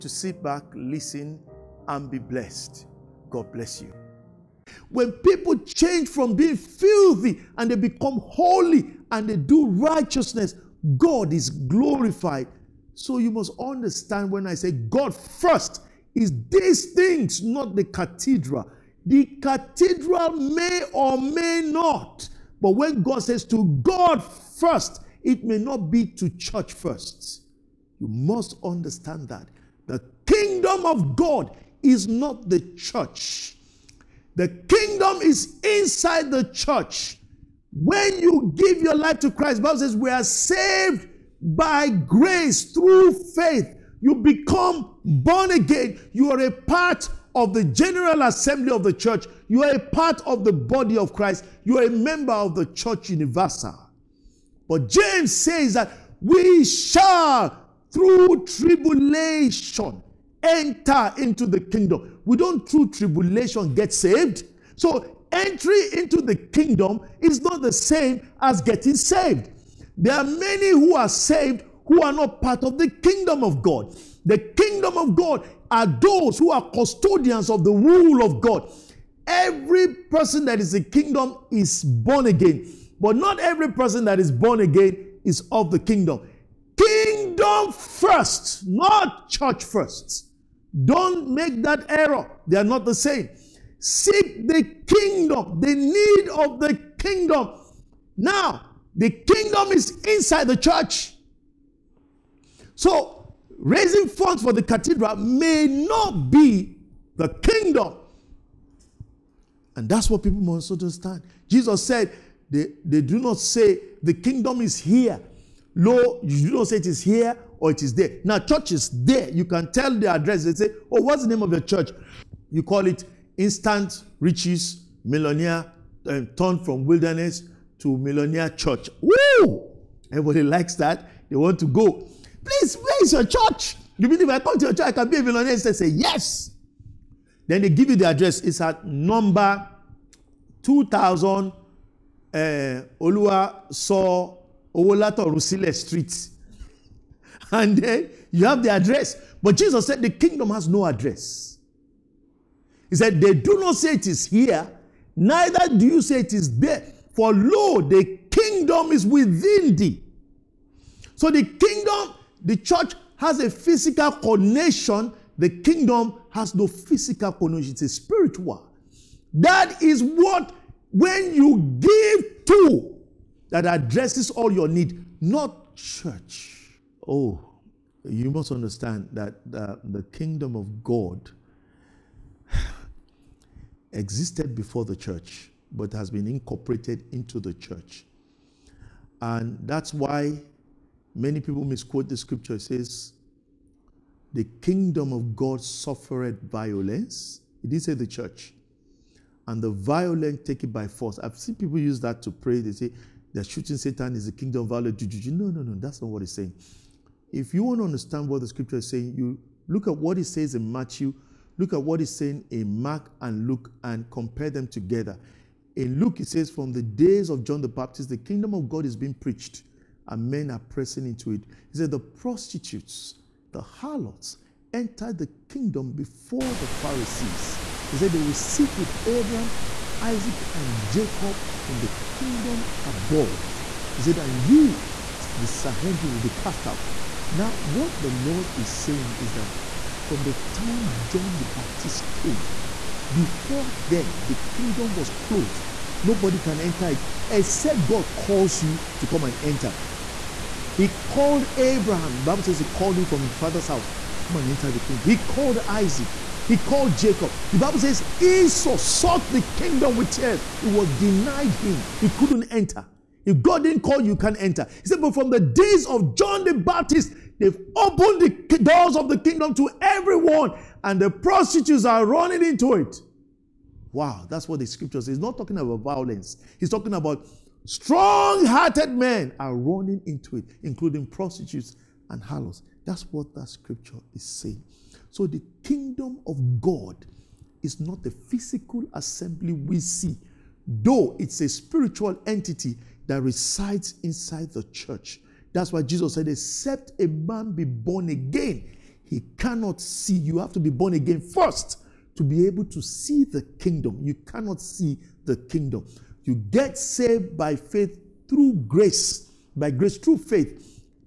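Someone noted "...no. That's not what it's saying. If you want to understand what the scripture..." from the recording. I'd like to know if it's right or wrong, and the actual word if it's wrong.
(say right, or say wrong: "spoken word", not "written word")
right.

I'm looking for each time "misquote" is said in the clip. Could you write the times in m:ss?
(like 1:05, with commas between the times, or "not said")
3:11.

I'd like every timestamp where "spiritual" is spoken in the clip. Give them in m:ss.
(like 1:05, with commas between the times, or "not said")
2:47, 4:51.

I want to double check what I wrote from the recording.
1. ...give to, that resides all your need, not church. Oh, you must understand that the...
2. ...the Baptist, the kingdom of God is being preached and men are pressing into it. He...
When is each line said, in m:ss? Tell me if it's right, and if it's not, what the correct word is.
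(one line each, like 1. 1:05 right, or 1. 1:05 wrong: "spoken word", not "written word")
1. 2:51 wrong: "addresses", not "resides"
2. 3:37 right.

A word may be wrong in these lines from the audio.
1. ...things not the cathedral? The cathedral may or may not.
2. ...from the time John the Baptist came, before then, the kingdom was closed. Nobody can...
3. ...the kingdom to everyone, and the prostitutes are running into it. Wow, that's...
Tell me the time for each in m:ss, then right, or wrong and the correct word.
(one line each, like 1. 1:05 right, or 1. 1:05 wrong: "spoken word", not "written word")
1. 0:16 right
2. 4:00 right
3. 4:29 right.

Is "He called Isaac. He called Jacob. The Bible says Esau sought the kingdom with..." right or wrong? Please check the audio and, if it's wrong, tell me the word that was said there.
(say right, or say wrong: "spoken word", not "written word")
right.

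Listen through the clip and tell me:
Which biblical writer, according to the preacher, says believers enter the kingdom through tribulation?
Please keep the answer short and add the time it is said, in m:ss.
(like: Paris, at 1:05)
James, at 0:54.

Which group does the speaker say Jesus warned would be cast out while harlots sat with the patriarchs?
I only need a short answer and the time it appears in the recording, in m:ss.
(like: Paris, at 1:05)
the Sanhedrin, at 3:55.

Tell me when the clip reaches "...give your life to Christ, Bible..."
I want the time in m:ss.
0:38.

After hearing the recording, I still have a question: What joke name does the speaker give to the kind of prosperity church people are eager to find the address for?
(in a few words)
Instant Riches Millionaire.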